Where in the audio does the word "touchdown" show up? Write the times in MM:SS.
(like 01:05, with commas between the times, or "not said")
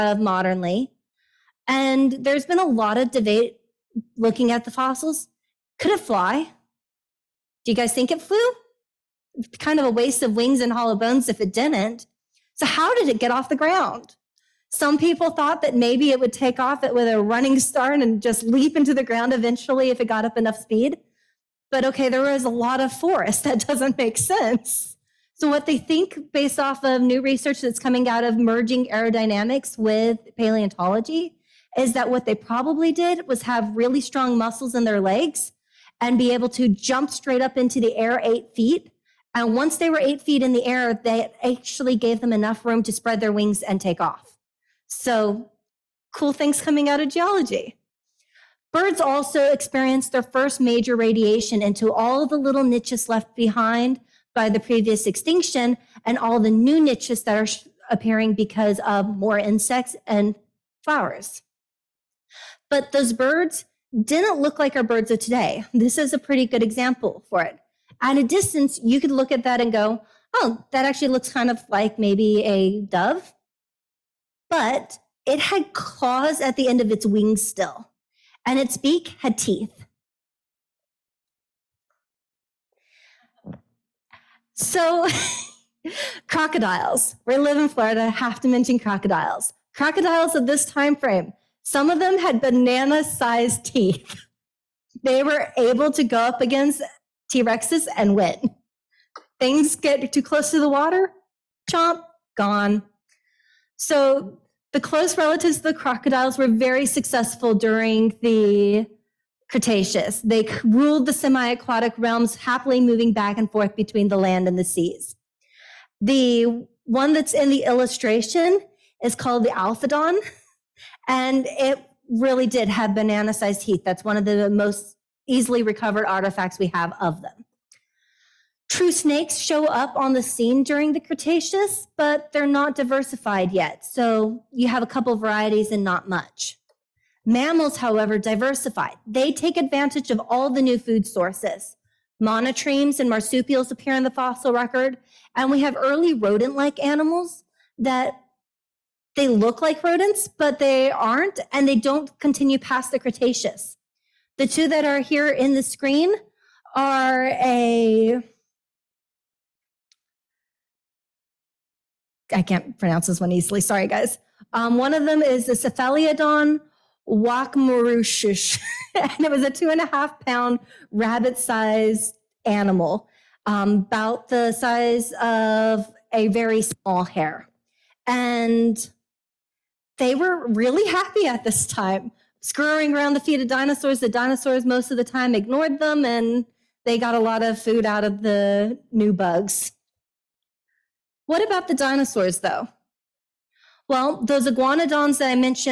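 not said.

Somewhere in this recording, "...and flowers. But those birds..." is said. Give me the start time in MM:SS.
01:00.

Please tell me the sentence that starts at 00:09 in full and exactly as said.
Kind of a waste of wings and hollow bones if it didn't.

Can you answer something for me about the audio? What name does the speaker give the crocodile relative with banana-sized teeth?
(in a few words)
Alphadon.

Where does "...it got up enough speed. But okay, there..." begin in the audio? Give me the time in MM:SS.
00:19.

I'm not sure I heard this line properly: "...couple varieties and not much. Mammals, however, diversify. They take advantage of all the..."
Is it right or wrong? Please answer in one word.
right.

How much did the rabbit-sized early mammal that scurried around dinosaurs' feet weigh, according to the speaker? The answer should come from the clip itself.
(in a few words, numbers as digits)
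2.5 pounds.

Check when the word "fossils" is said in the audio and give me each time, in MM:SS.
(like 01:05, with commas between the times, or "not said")
00:04, 02:24.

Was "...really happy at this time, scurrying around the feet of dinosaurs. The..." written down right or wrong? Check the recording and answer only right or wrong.
right.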